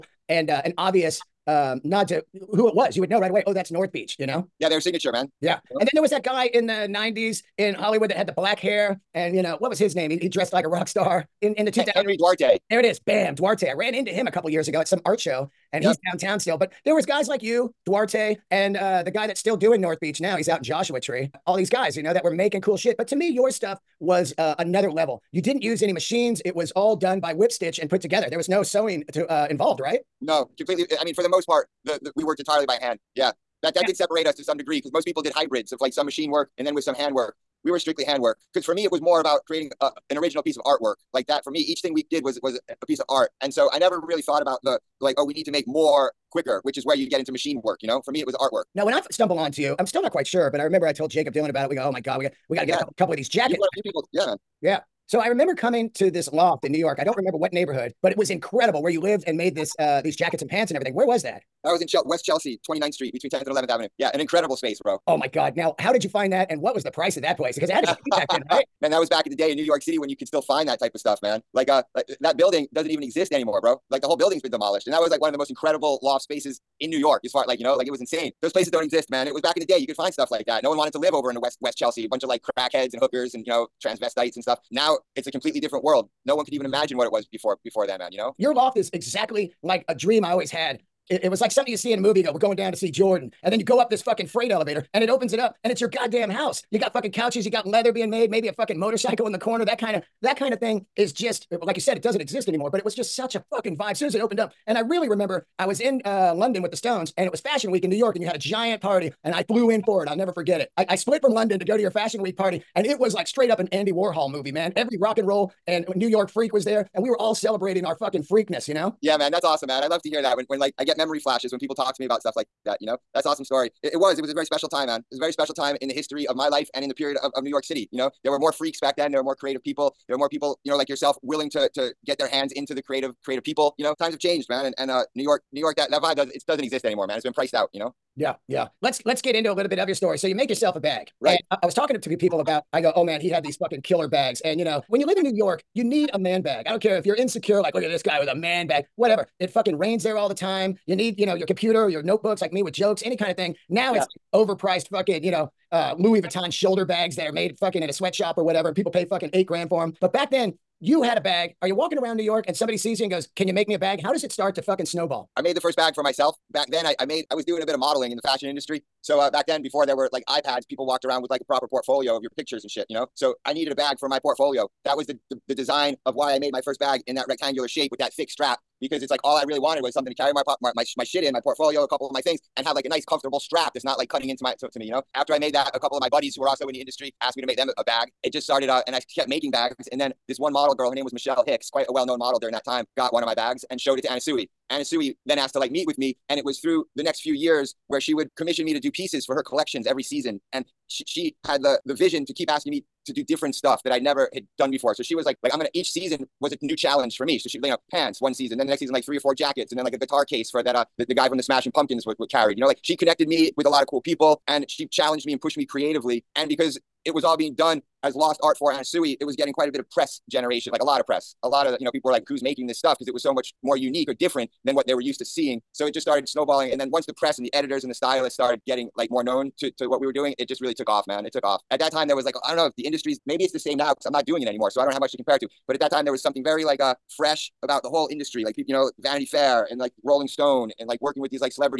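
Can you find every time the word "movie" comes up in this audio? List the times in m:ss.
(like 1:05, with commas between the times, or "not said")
1:31, 1:54.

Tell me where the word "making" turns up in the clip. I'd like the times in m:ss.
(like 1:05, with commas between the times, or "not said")
0:22, 3:09, 3:42.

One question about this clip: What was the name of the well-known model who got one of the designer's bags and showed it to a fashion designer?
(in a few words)
Michelle Hicks.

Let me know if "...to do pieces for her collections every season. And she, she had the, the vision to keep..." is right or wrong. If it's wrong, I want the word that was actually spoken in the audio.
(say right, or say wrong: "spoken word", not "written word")
right.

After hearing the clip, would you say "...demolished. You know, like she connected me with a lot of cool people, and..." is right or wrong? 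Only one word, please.
wrong.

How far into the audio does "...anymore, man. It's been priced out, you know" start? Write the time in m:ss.
2:16.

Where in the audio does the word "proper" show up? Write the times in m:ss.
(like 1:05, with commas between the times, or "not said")
2:51.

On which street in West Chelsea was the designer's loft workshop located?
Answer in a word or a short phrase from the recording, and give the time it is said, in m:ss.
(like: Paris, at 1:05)
29th Street, at 1:02.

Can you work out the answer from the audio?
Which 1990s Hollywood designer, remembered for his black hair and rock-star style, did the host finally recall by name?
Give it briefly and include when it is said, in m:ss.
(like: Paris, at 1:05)
Henry Duarte, at 0:11.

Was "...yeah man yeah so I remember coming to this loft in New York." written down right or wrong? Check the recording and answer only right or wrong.
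right.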